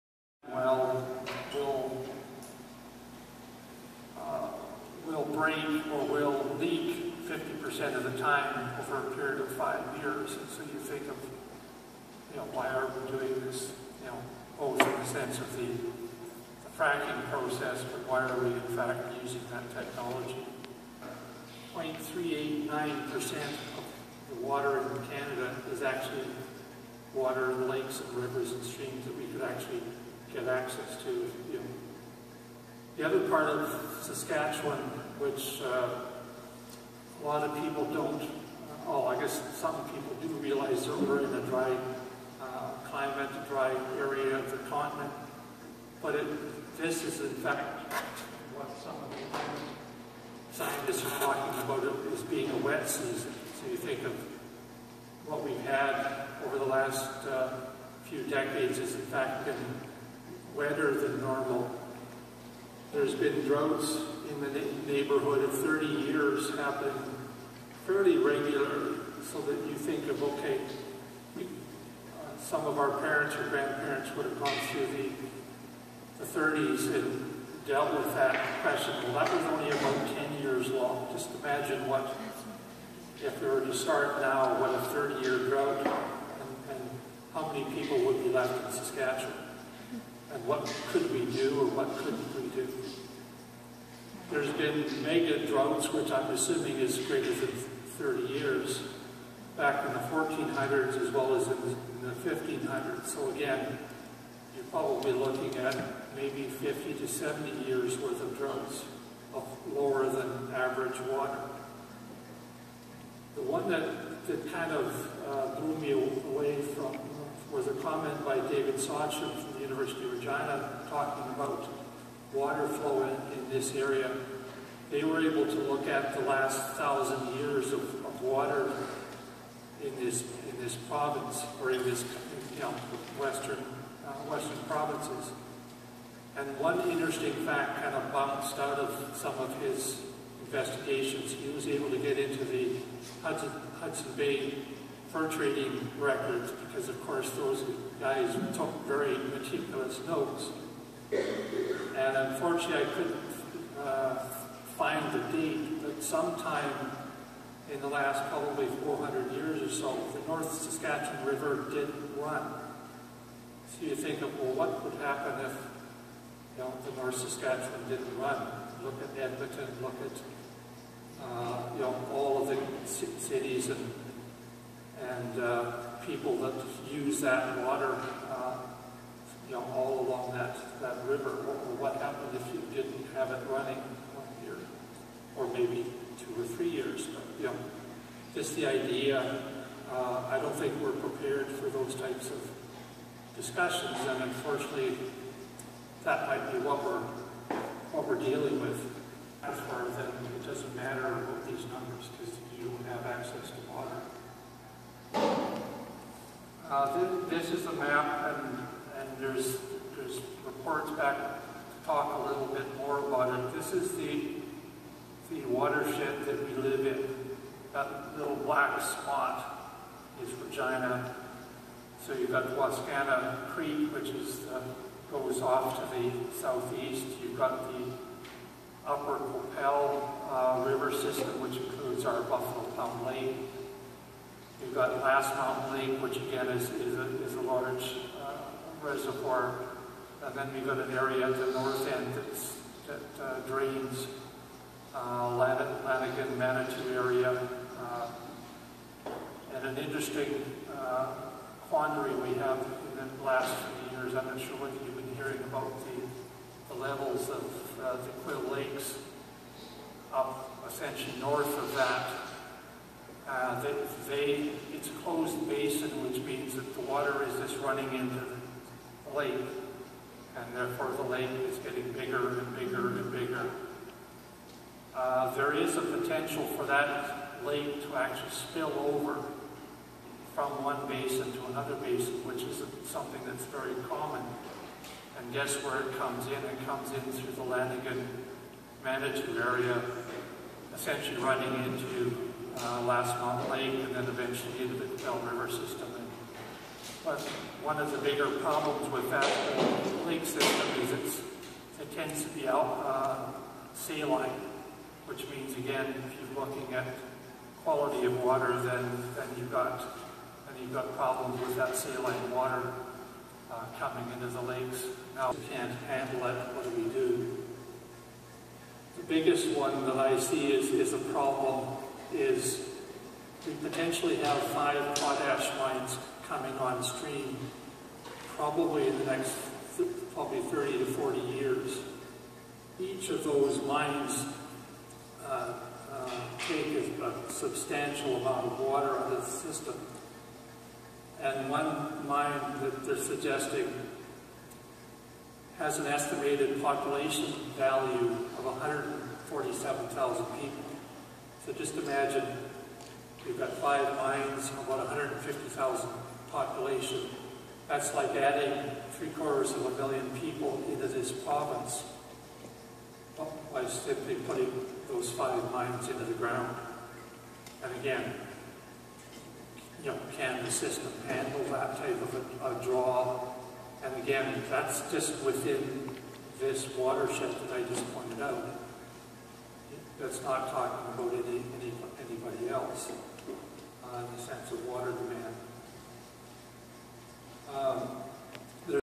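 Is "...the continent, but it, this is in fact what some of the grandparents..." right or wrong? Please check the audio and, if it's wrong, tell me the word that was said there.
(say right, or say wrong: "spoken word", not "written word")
wrong: "scientists", not "grandparents".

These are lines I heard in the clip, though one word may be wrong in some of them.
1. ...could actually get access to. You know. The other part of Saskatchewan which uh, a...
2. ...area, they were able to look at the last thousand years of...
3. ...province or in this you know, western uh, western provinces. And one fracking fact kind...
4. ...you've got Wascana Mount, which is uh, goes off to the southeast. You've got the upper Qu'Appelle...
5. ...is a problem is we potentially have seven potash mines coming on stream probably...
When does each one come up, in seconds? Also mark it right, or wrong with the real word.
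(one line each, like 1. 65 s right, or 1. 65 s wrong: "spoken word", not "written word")
1. 29 s right
2. 123 s right
3. 130 s wrong: "interesting", not "fracking"
4. 222 s wrong: "Creek", not "Mount"
5. 320 s wrong: "five", not "seven".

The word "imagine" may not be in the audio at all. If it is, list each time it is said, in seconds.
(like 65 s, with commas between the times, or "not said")
81 s, 351 s.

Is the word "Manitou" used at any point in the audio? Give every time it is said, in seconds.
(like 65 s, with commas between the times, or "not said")
246 s, 288 s.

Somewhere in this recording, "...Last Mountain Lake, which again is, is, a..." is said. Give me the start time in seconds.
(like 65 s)
235 s.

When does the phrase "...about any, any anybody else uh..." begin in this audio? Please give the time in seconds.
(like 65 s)
380 s.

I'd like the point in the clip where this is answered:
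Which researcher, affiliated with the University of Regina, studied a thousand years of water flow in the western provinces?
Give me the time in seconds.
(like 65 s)
118 s.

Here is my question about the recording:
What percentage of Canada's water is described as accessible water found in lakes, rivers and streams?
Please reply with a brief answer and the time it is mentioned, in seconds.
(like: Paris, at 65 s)
0.389%, at 21 s.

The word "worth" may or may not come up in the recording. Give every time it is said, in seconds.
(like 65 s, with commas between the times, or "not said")
107 s.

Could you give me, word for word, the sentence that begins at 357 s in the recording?
That's like adding three quarters of a million people into this province by simply putting those five mines into the ground.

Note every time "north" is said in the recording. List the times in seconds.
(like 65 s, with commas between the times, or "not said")
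160 s, 167 s, 241 s, 261 s.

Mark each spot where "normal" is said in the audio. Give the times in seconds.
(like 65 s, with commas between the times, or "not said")
61 s.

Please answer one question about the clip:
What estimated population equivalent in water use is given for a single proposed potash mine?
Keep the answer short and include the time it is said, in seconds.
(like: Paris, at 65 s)
147,000 people, at 348 s.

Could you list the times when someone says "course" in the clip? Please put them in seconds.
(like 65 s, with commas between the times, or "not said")
147 s.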